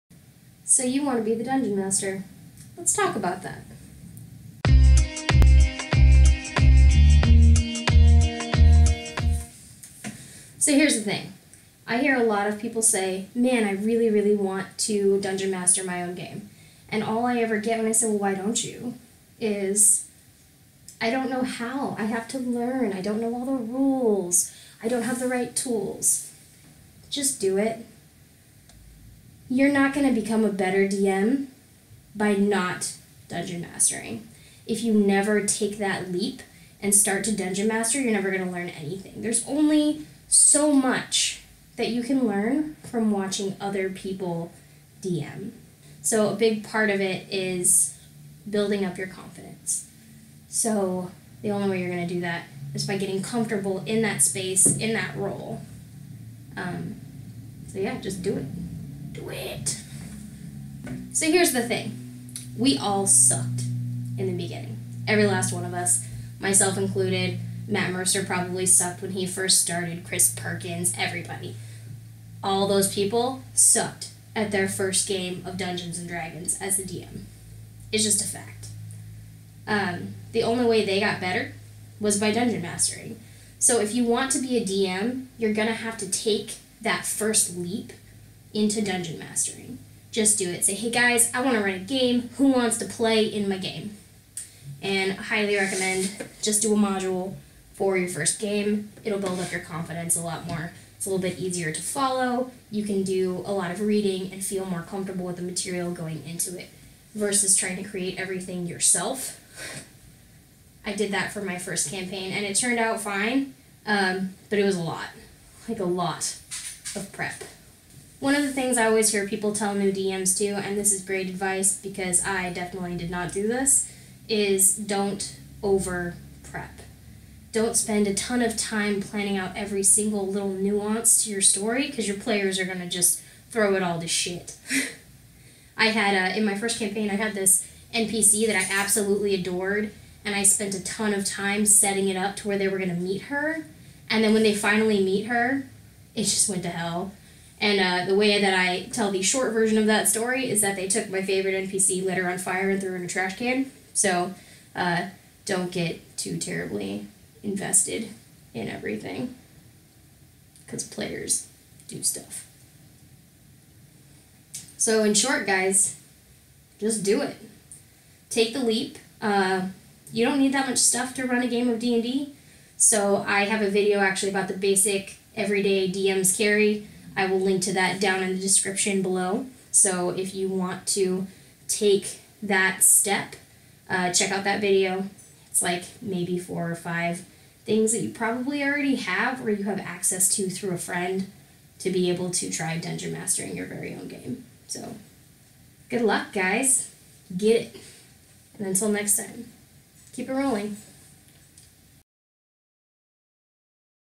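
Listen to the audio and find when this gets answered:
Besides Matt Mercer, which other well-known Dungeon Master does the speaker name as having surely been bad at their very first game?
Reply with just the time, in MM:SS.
01:10.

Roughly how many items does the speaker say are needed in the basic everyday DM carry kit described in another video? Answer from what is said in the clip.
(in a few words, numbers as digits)
4 or 5.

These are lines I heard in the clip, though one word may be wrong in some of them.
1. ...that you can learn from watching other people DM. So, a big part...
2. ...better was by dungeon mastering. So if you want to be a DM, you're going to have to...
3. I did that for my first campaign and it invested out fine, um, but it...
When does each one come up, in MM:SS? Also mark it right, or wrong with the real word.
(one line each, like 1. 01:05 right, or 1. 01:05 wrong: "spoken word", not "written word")
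1. 00:41 right
2. 01:21 right
3. 01:50 wrong: "turned", not "invested".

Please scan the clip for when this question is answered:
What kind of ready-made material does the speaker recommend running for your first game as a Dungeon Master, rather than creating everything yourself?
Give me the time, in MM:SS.
01:36.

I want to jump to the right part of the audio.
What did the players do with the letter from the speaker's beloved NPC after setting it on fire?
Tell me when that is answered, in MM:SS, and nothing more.
02:32.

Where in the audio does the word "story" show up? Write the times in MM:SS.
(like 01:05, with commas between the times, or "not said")
02:11, 02:30.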